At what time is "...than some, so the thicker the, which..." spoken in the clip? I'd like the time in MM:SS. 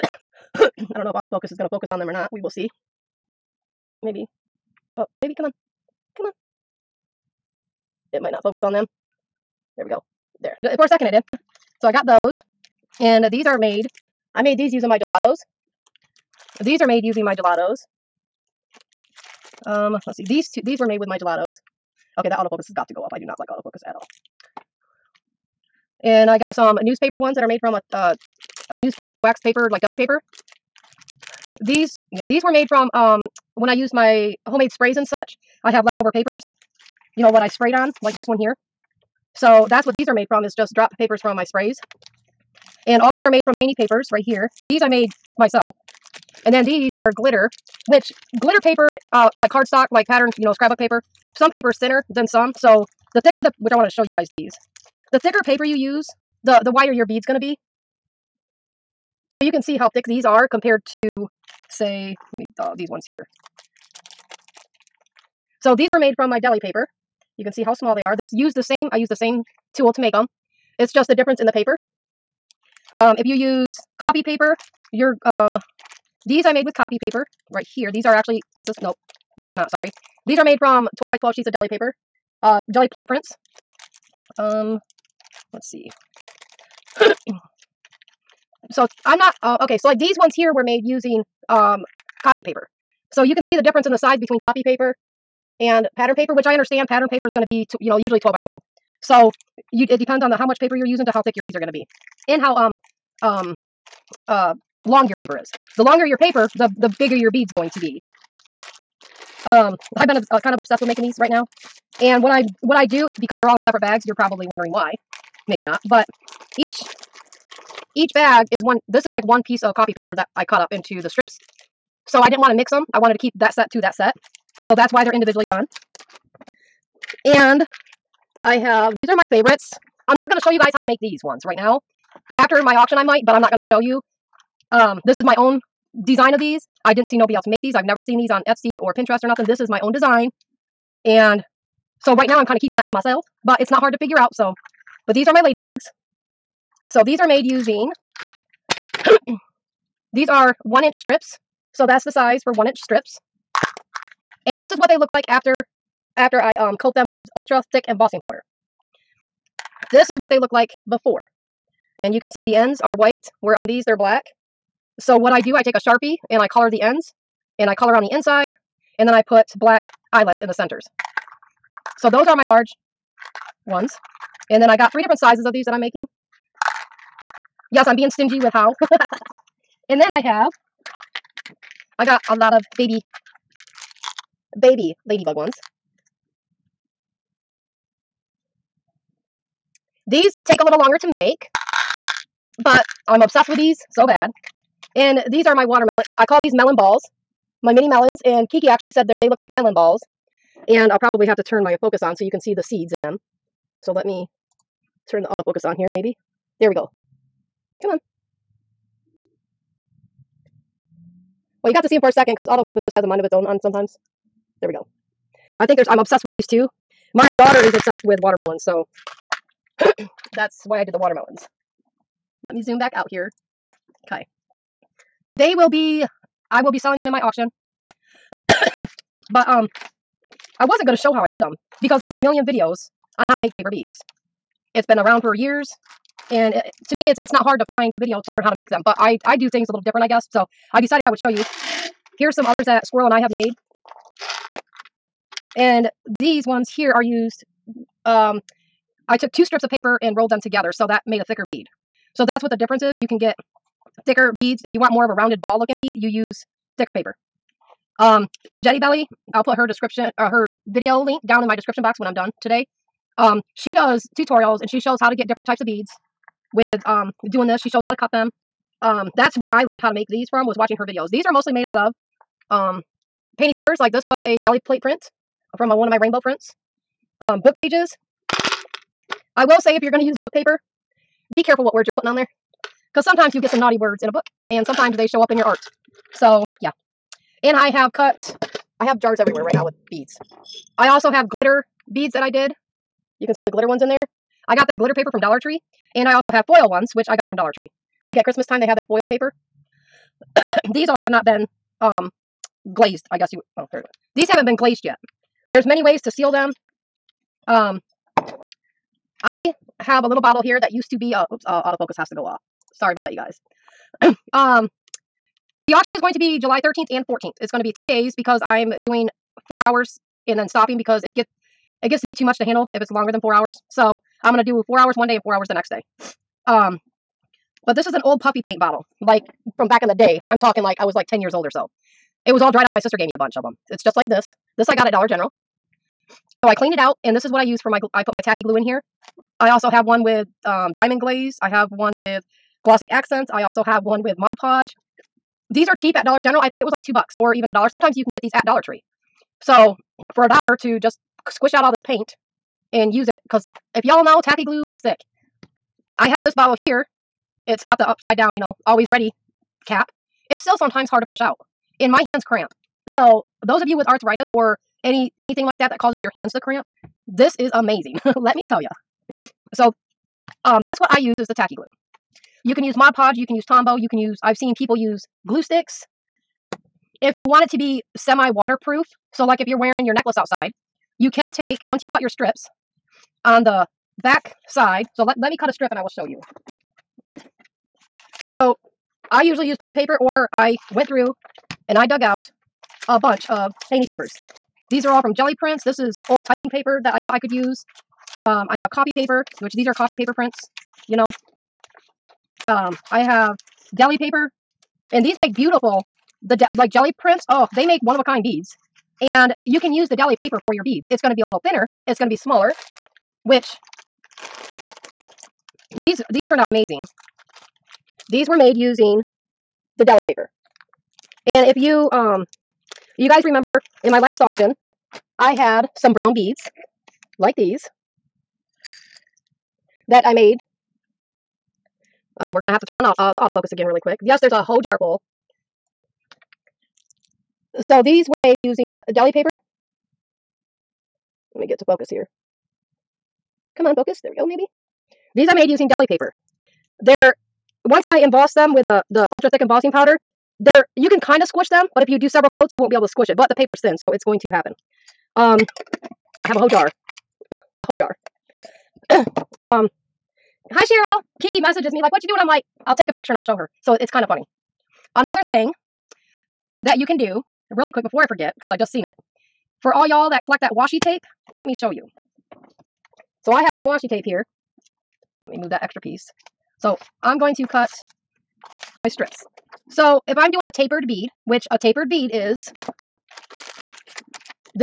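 00:52.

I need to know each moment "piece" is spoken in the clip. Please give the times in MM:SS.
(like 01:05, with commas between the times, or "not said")
01:59, 07:55.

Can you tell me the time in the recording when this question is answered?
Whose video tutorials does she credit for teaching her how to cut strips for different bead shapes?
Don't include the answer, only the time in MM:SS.
04:18.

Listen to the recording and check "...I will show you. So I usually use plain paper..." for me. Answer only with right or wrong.
right.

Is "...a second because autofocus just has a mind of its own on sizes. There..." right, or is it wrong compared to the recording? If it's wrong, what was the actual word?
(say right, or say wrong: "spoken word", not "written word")
wrong: "sometimes", not "sizes".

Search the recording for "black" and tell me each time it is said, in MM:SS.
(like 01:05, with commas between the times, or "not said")
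02:43, 02:49.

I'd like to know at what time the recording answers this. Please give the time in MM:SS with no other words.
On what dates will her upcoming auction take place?
05:16.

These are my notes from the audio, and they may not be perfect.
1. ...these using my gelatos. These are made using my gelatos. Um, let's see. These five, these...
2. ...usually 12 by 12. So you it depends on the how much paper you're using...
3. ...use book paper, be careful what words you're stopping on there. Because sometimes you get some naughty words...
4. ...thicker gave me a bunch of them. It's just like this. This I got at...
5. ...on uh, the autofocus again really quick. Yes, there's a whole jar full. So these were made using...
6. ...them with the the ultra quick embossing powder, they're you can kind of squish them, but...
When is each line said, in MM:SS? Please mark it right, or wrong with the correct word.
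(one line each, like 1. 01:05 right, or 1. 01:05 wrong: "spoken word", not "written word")
1. 00:14 wrong: "two", not "five"
2. 01:37 right
3. 04:40 wrong: "putting", not "stopping"
4. 05:32 wrong: "sister", not "thicker"
5. 07:12 right
6. 07:28 wrong: "thick", not "quick".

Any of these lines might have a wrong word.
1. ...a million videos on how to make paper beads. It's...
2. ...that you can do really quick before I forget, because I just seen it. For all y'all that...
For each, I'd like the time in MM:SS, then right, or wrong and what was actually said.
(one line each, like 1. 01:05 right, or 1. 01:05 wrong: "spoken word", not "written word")
1. 03:52 right
2. 07:46 right.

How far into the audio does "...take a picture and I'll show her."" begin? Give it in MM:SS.
07:42.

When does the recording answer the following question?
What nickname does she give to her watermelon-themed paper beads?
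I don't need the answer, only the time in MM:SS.
03:17.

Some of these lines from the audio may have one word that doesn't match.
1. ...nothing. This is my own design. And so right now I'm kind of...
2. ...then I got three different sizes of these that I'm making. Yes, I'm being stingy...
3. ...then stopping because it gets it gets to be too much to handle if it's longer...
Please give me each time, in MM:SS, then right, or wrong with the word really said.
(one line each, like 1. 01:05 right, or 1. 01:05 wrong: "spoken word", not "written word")
1. 02:19 right
2. 02:54 right
3. 05:20 right.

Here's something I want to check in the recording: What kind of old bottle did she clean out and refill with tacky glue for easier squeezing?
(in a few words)
puffy paint bottle.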